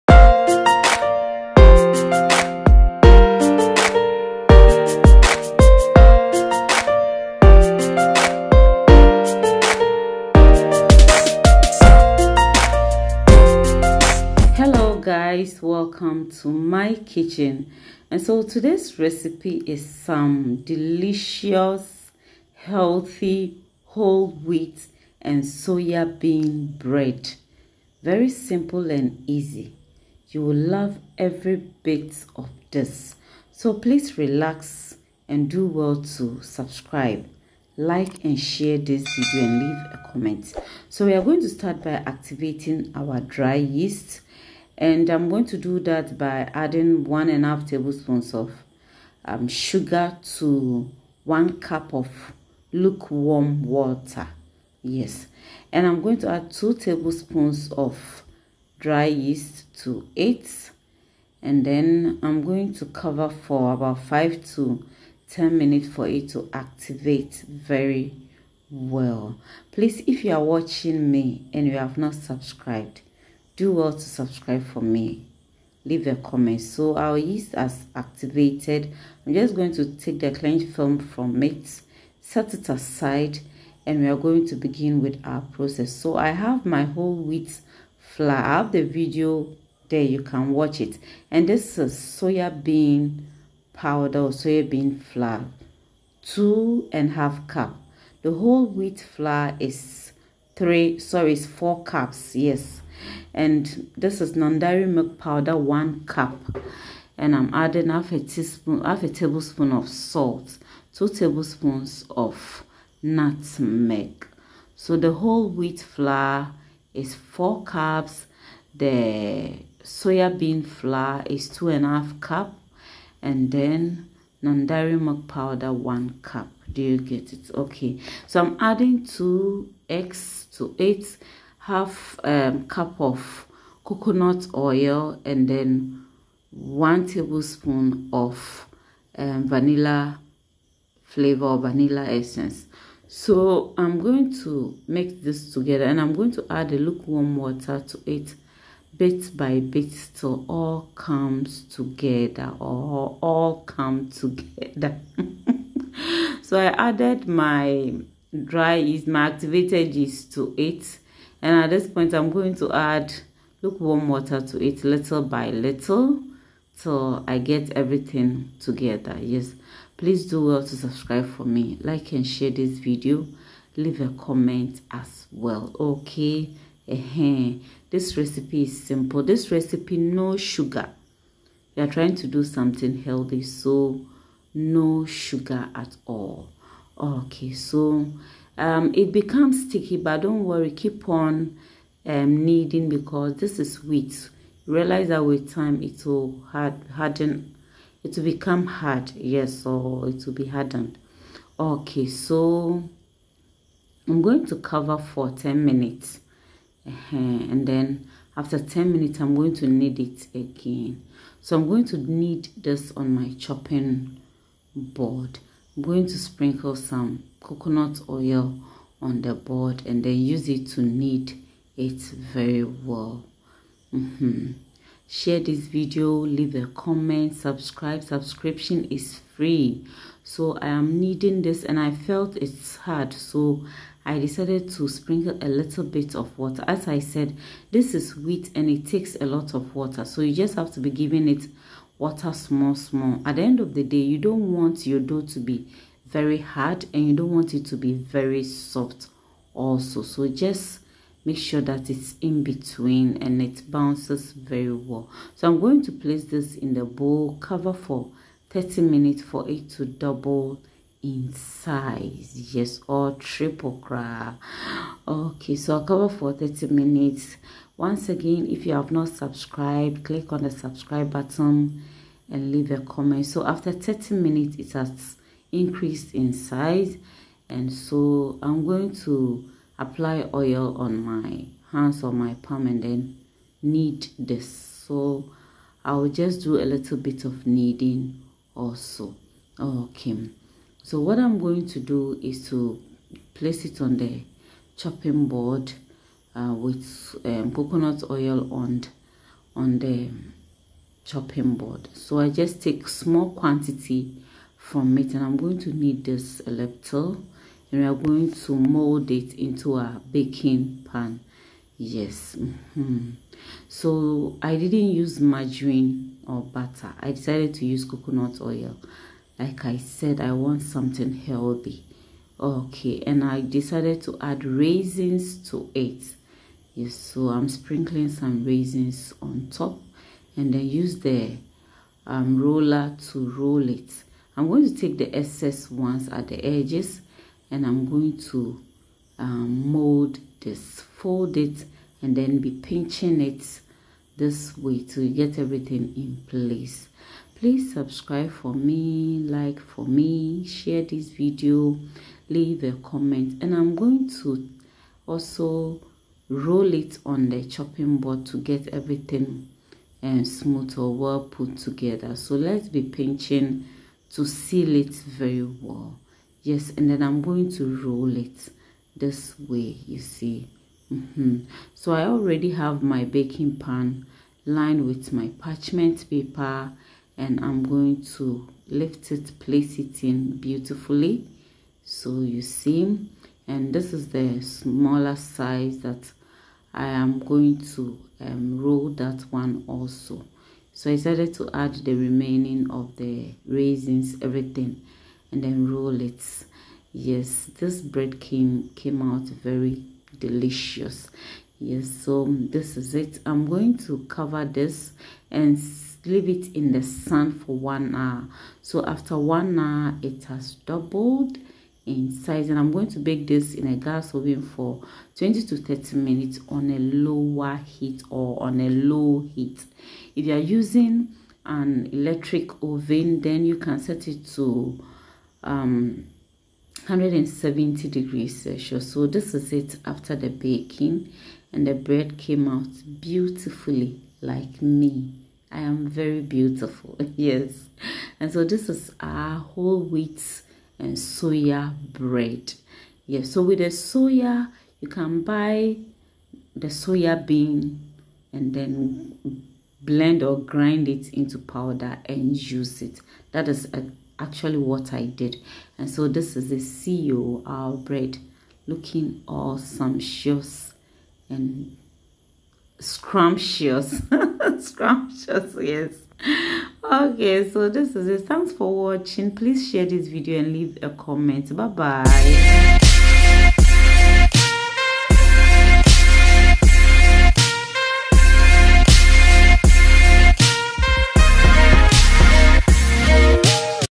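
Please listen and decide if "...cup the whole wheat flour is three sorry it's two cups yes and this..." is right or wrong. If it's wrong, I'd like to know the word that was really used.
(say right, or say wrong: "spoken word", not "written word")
wrong: "four", not "two".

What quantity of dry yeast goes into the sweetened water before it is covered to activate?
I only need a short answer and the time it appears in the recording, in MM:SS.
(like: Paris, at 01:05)
2 tablespoons, at 00:56.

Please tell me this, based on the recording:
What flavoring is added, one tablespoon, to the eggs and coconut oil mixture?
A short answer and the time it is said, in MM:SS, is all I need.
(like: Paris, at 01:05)
Vanilla essence, at 02:21.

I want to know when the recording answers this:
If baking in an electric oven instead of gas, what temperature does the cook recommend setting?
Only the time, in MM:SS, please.
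07:06.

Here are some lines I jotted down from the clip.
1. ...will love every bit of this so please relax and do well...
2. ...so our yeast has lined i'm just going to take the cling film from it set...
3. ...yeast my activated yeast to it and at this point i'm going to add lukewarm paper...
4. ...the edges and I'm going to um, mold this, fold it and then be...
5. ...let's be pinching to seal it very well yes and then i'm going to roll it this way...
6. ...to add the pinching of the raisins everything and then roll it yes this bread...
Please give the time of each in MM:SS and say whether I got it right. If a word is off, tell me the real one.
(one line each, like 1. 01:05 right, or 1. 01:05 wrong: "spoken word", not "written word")
1. 00:30 right
2. 01:16 wrong: "activated", not "lined"
3. 02:38 wrong: "water", not "paper"
4. 05:36 right
5. 06:02 right
6. 06:31 wrong: "remaining", not "pinching".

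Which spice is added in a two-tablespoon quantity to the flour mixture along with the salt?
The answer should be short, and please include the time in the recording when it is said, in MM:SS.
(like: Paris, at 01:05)
Nutmeg, at 01:53.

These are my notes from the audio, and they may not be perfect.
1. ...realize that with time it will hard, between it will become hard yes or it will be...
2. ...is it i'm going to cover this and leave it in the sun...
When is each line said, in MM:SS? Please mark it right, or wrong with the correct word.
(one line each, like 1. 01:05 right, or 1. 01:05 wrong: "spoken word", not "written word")
1. 03:14 wrong: "harden", not "between"
2. 06:42 right.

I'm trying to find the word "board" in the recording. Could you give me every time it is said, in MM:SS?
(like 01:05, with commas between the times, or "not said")
03:34, 03:39, 04:55, 05:01, 05:57.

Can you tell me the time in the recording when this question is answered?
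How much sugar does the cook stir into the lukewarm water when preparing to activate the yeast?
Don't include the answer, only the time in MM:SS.
00:47.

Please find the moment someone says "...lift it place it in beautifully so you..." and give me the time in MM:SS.
06:18.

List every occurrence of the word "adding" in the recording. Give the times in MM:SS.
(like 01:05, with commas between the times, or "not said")
00:46, 01:47, 02:08.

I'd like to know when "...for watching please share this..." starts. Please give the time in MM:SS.
07:48.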